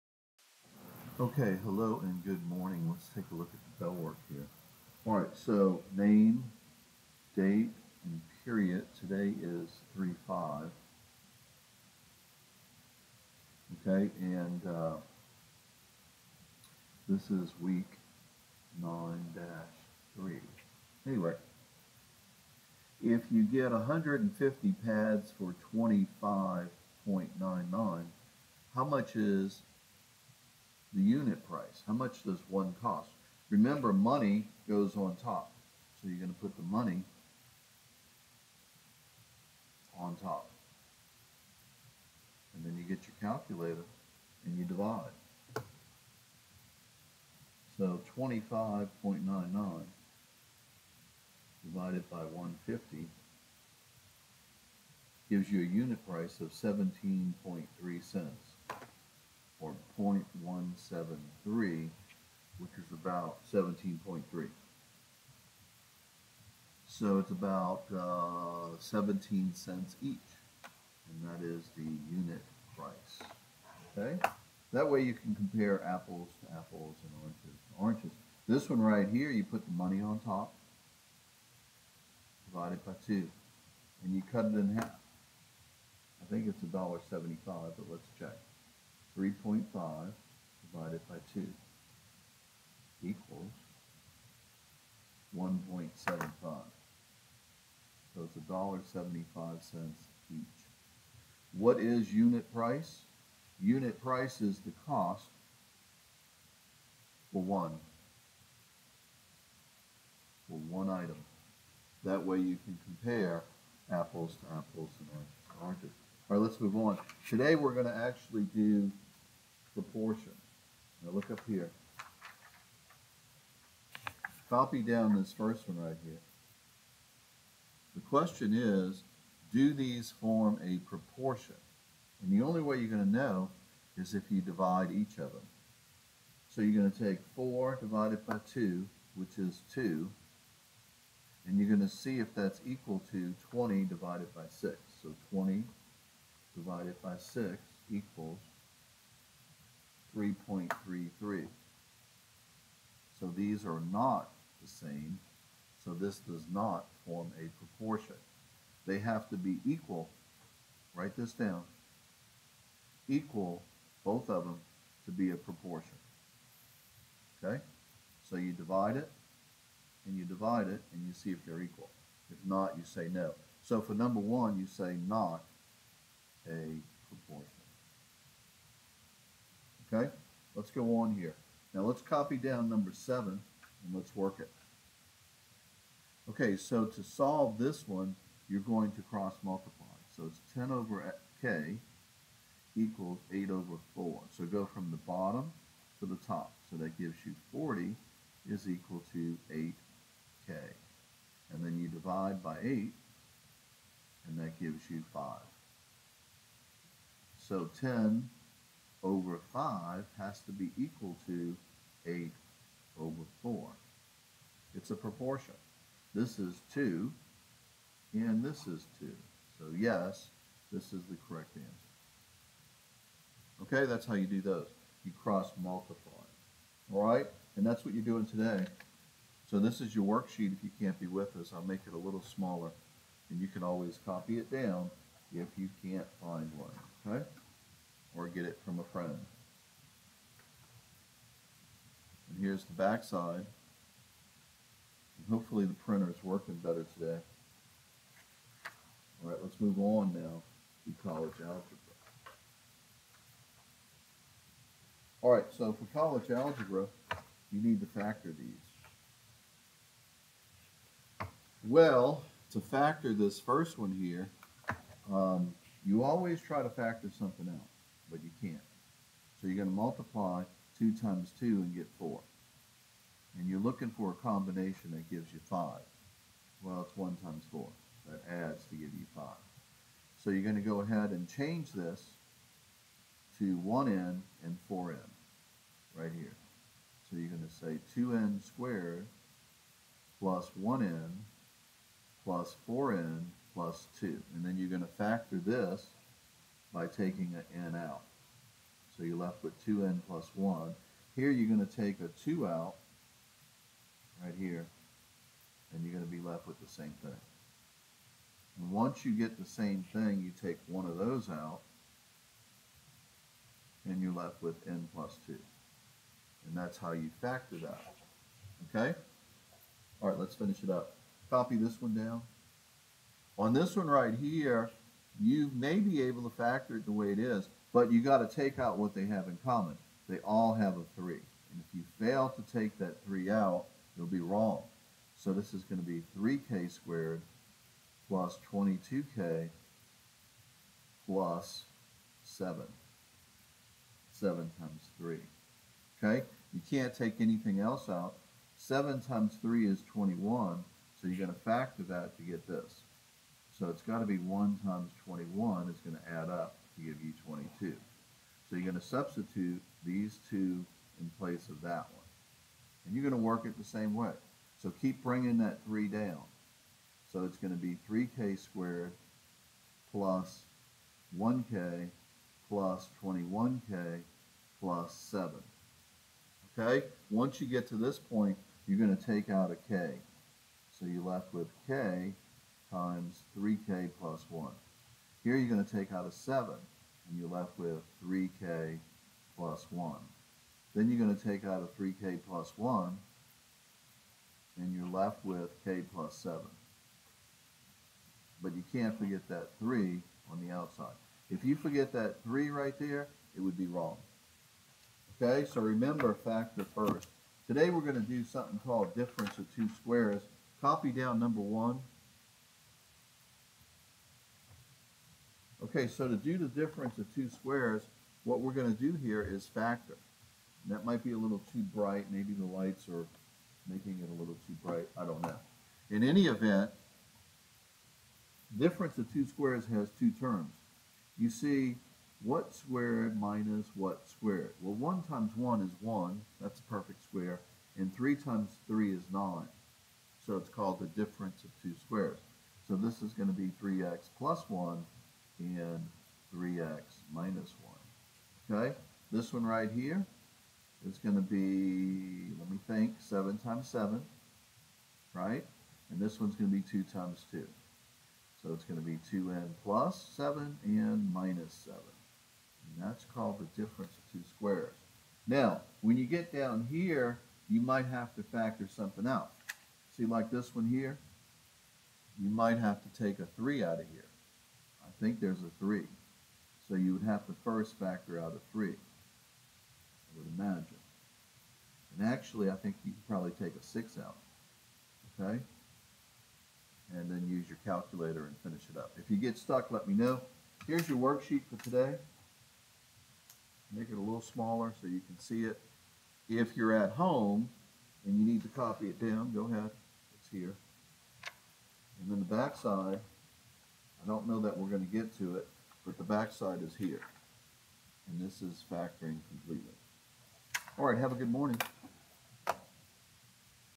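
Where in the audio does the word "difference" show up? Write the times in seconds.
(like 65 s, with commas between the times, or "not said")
408 s, 416 s, 428 s, 440 s, 463 s.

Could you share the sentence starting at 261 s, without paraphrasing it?
Well, to factor this first one here, um, you always try to factor something out but you can't.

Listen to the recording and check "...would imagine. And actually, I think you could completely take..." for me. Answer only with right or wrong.
wrong.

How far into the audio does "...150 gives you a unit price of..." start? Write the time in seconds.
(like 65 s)
52 s.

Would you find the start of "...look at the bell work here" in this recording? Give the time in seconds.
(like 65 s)
3 s.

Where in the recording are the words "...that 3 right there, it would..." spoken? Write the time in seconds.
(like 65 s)
401 s.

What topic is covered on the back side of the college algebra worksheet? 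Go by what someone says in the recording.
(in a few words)
factoring completely.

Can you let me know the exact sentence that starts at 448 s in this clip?
Okay, this one right here is going to be, let me think, 7 times 7, right?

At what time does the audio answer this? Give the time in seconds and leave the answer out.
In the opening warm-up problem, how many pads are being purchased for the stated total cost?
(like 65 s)
23 s.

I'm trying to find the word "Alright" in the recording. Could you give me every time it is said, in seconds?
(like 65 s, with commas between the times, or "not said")
249 s, 255 s.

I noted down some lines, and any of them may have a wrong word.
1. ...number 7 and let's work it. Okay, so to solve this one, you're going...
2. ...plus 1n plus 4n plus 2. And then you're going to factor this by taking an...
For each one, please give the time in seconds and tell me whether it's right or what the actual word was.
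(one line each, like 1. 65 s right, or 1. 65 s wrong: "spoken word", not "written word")
1. 182 s right
2. 290 s right.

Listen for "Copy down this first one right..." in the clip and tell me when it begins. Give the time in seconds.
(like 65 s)
124 s.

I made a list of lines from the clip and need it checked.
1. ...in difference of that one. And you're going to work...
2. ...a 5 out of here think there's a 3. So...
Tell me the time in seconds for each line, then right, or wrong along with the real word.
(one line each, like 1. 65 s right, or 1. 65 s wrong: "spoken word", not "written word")
1. 360 s wrong: "place", not "difference"
2. 473 s wrong: "3", not "5".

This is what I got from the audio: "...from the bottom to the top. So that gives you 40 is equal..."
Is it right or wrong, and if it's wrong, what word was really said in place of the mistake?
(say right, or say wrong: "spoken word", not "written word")
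right.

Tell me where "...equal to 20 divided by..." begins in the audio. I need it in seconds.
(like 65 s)
142 s.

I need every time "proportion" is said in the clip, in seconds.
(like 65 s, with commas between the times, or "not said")
119 s, 130 s, 157 s, 165 s, 177 s, 214 s.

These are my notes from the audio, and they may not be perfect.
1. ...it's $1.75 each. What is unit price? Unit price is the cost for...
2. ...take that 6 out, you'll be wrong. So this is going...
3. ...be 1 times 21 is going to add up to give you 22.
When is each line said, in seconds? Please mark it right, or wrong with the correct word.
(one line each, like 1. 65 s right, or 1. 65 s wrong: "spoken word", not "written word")
1. 98 s right
2. 332 s wrong: "3", not "6"
3. 354 s right.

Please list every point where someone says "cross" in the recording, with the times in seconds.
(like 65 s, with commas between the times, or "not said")
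189 s, 225 s.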